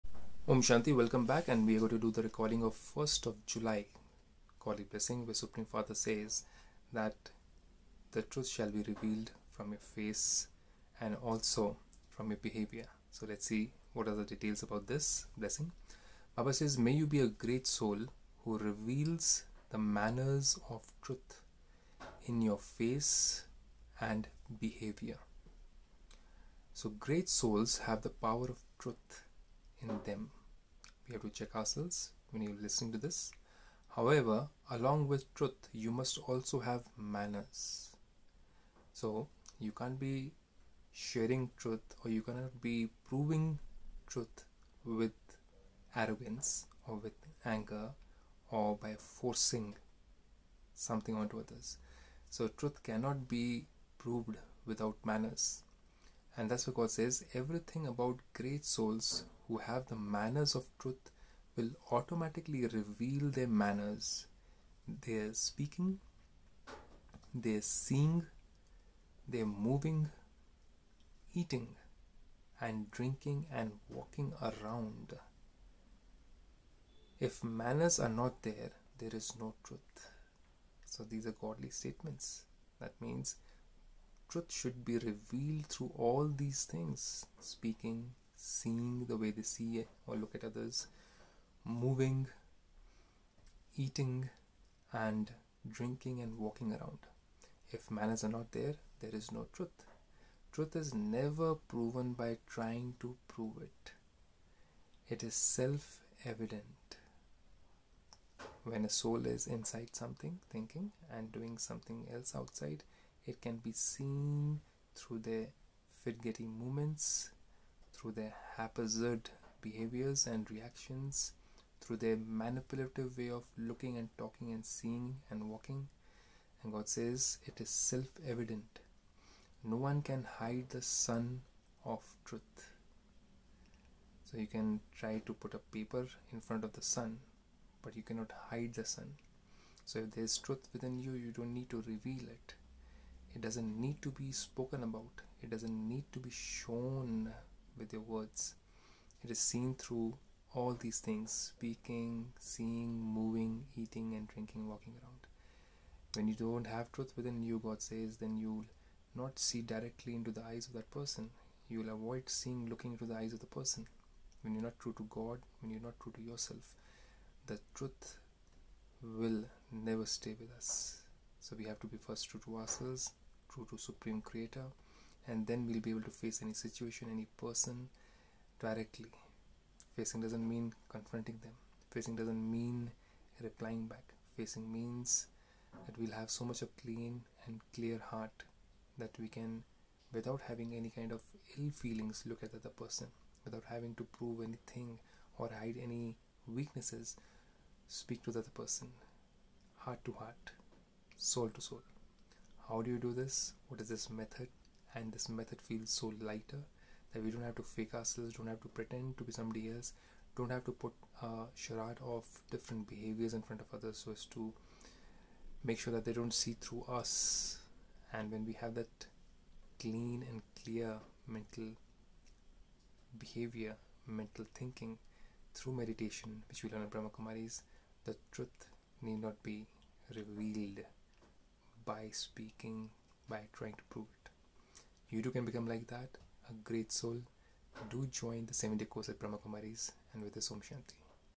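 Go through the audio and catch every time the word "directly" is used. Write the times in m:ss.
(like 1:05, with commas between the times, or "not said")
2:39, 2:58.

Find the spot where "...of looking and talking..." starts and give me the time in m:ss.
2:03.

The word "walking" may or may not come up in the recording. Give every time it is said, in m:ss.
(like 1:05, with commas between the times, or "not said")
1:13, 1:36, 2:05, 2:34.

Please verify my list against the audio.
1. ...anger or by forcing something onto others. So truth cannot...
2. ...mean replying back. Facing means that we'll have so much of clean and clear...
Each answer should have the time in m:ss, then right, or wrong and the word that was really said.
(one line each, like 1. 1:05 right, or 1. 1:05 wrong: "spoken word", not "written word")
1. 0:47 right
2. 3:02 right.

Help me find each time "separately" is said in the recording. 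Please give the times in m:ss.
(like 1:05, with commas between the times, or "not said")
not said.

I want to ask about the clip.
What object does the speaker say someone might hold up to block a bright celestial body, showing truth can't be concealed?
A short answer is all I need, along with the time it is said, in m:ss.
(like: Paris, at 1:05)
paper, at 2:15.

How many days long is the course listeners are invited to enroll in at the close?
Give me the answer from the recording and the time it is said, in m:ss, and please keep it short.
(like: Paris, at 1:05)
7, at 3:58.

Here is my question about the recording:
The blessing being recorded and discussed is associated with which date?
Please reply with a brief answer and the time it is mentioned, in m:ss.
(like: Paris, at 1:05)
1st of July, at 0:02.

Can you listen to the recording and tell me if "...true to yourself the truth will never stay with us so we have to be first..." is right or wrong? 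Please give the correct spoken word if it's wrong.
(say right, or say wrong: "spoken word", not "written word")
right.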